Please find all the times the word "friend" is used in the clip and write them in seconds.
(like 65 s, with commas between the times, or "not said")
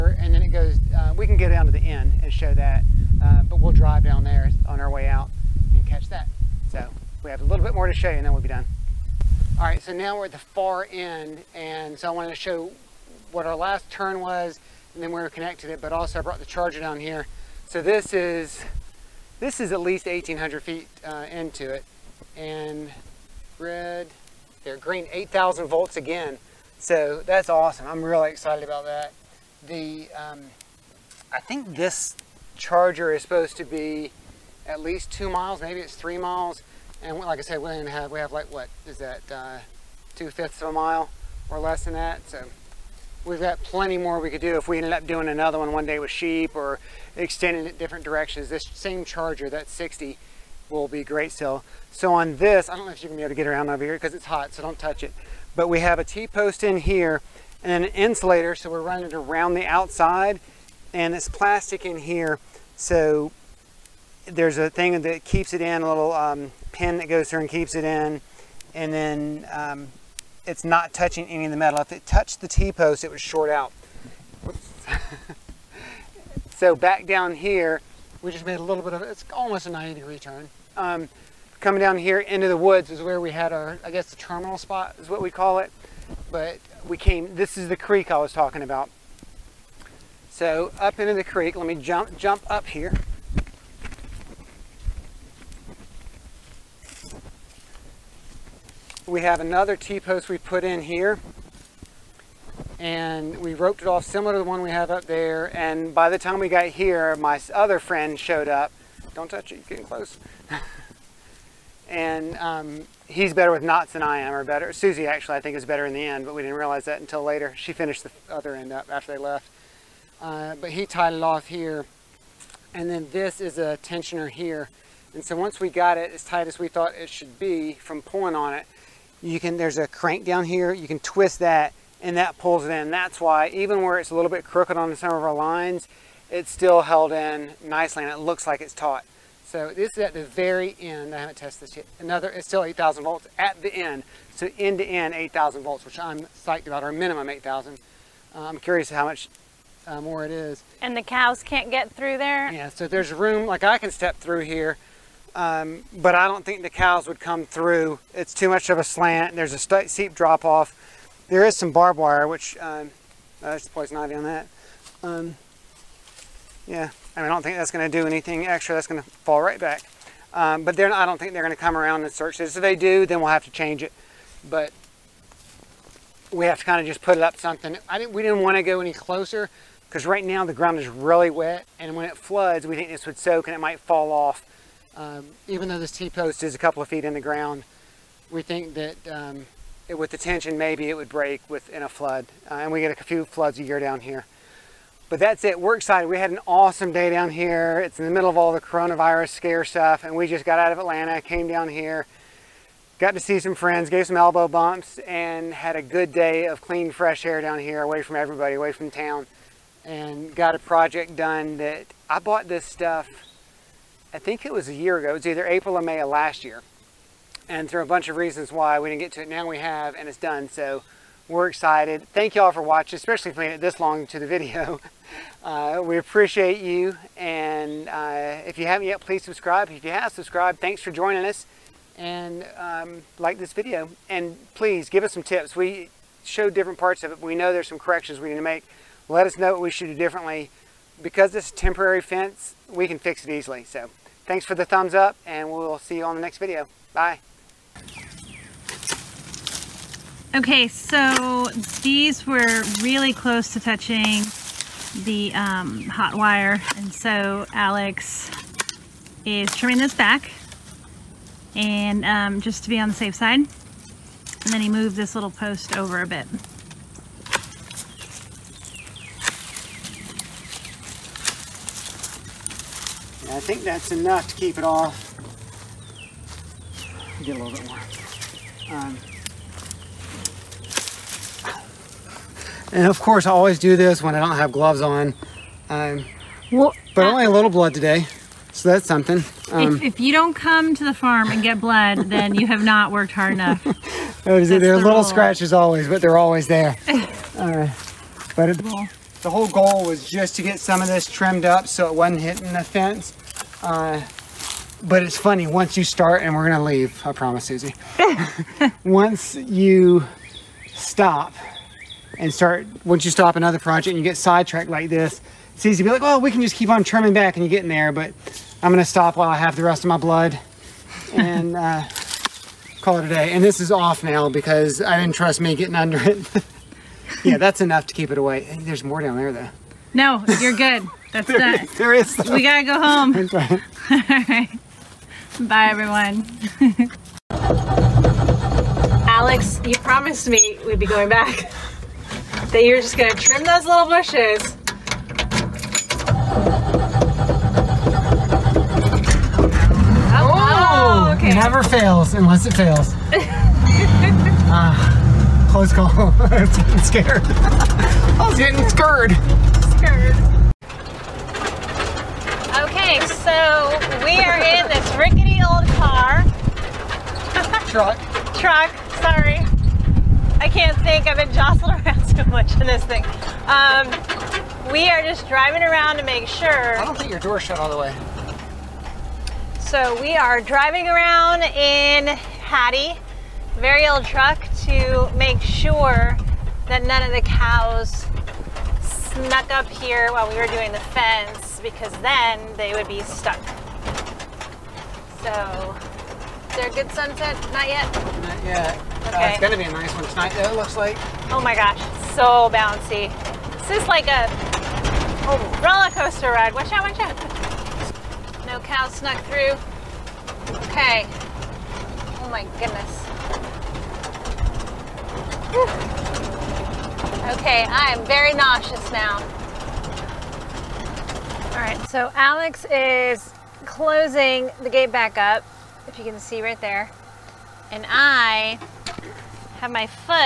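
107 s, 203 s.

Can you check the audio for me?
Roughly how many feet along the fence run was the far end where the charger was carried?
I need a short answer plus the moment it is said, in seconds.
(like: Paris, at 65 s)
1800 feet, at 20 s.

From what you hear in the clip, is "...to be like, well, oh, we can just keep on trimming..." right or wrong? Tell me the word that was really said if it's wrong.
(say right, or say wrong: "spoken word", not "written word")
right.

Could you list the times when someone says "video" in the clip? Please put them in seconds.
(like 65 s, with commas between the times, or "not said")
224 s, 233 s, 246 s.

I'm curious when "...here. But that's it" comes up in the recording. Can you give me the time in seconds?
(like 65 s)
194 s.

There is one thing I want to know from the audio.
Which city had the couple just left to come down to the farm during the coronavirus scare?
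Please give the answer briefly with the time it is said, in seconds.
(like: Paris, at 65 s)
Atlanta, at 200 s.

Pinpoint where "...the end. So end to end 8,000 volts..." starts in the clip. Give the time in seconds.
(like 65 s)
143 s.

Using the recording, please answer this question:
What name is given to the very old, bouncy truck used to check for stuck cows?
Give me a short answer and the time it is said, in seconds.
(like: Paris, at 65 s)
Hattie, at 382 s.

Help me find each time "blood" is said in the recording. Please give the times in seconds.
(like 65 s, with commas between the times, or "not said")
287 s, 291 s, 319 s.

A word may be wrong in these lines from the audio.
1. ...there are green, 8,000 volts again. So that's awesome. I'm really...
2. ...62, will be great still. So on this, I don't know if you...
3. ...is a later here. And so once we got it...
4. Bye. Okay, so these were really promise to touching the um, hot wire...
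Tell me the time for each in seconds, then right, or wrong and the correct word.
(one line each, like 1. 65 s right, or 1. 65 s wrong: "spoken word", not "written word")
1. 24 s right
2. 49 s wrong: "60", not "62"
3. 123 s wrong: "tensioner", not "later"
4. 246 s wrong: "close", not "promise".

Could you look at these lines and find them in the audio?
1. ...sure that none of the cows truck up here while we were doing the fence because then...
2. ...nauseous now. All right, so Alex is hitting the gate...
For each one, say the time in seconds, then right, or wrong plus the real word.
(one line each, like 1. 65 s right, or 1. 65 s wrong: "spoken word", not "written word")
1. 385 s wrong: "snuck", not "truck"
2. 418 s wrong: "closing", not "hitting".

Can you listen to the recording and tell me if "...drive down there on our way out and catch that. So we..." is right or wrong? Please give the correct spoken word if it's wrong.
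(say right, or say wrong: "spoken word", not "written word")
right.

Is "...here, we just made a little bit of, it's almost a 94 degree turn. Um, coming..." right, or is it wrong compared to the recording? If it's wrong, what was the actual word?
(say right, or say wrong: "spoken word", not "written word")
wrong: "90", not "94".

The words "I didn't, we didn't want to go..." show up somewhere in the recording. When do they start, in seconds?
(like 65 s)
177 s.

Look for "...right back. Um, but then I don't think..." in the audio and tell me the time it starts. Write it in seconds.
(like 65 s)
169 s.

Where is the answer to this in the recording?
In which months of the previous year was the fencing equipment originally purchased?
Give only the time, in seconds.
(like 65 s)
215 s.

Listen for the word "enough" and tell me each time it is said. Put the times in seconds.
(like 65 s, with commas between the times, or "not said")
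273 s, 293 s, 327 s.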